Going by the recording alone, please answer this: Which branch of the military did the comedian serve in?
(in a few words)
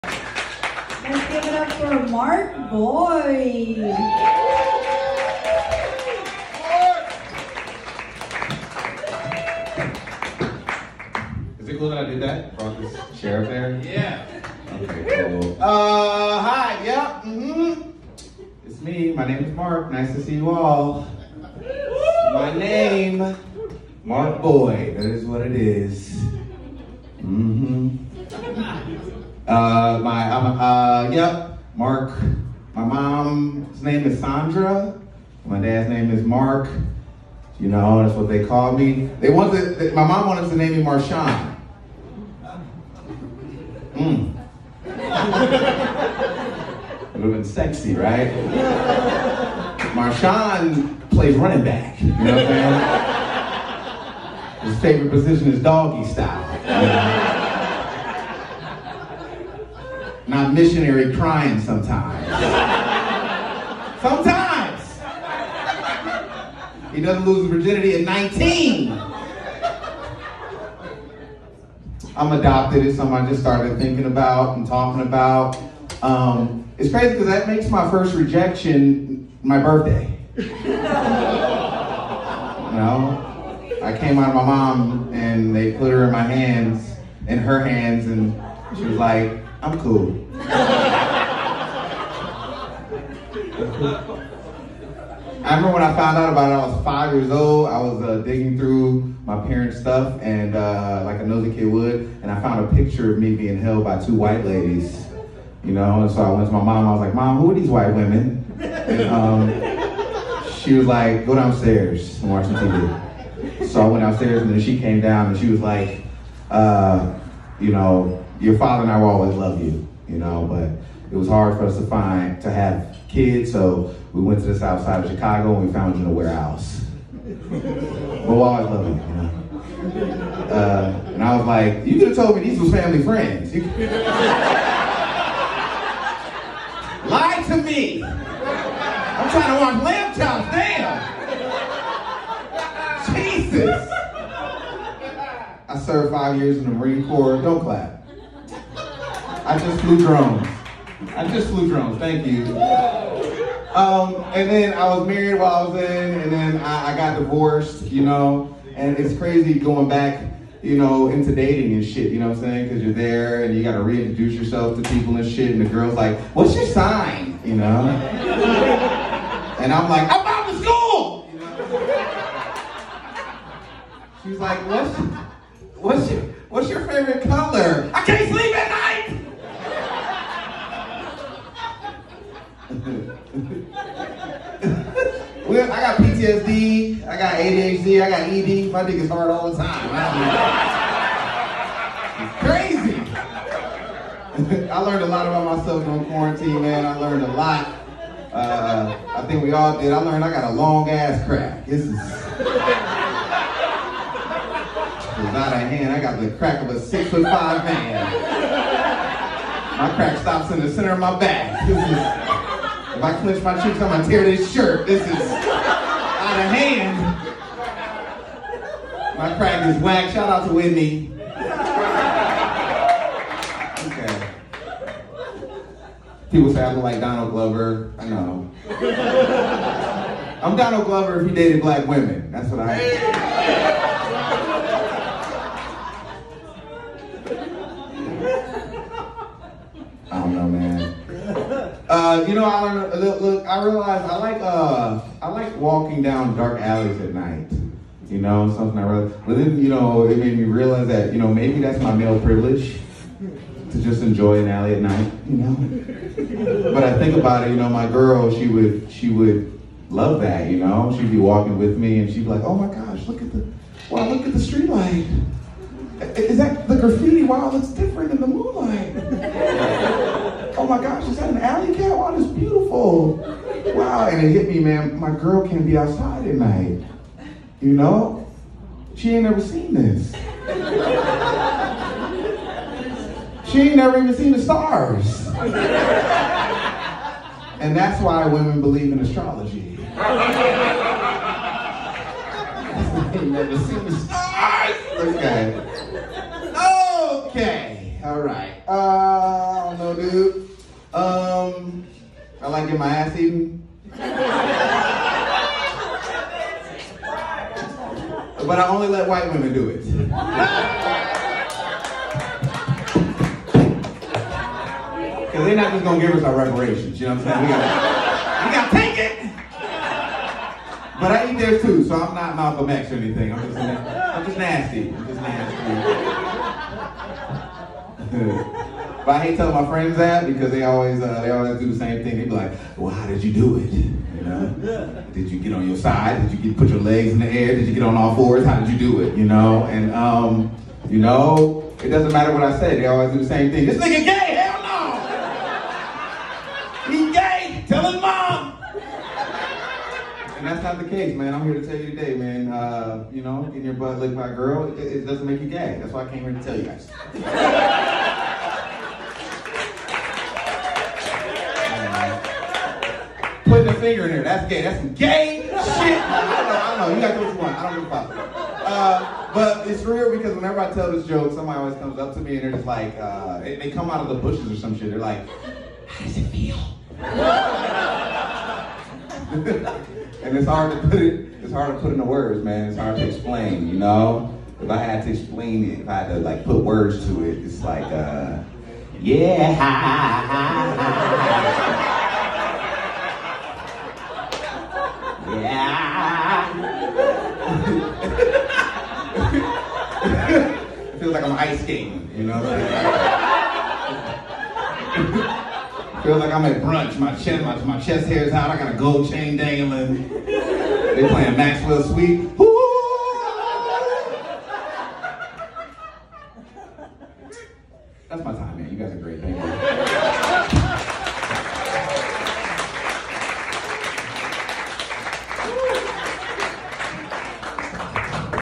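Marine Corps.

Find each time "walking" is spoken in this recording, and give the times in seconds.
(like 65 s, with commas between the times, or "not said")
245 s, 261 s.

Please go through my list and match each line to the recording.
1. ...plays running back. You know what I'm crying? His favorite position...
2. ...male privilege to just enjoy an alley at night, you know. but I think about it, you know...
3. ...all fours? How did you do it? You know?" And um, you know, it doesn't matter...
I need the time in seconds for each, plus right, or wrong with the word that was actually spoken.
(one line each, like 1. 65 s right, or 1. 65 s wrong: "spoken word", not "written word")
1. 51 s wrong: "saying", not "crying"
2. 251 s right
3. 337 s right.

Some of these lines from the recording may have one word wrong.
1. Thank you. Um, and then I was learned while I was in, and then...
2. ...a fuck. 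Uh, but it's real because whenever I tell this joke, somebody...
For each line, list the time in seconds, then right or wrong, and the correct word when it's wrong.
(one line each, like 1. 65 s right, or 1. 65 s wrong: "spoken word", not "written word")
1. 151 s wrong: "married", not "learned"
2. 367 s right.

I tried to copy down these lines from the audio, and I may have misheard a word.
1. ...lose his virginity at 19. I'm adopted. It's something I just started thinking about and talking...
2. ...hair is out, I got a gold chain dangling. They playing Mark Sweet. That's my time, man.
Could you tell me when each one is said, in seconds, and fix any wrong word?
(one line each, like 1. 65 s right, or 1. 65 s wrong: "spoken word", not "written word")
1. 67 s right
2. 408 s wrong: "Maxwell", not "Mark".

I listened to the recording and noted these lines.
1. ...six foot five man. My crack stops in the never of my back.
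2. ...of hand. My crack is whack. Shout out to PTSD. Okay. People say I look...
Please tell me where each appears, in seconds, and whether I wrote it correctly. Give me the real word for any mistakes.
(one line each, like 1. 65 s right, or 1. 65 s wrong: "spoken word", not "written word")
1. 206 s wrong: "center", not "never"
2. 216 s wrong: "Whitney", not "PTSD".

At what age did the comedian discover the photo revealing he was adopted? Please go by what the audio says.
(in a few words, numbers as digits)
5.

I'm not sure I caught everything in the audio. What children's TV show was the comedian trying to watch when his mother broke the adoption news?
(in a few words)
Lamb Chops.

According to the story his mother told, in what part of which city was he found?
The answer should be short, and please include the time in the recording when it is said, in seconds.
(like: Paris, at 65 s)
South side of Chicago, at 124 s.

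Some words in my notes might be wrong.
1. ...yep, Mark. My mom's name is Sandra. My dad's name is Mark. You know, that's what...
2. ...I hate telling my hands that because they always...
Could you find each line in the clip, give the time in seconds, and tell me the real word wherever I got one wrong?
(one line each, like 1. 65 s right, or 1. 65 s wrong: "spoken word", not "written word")
1. 31 s right
2. 329 s wrong: "friends", not "hands".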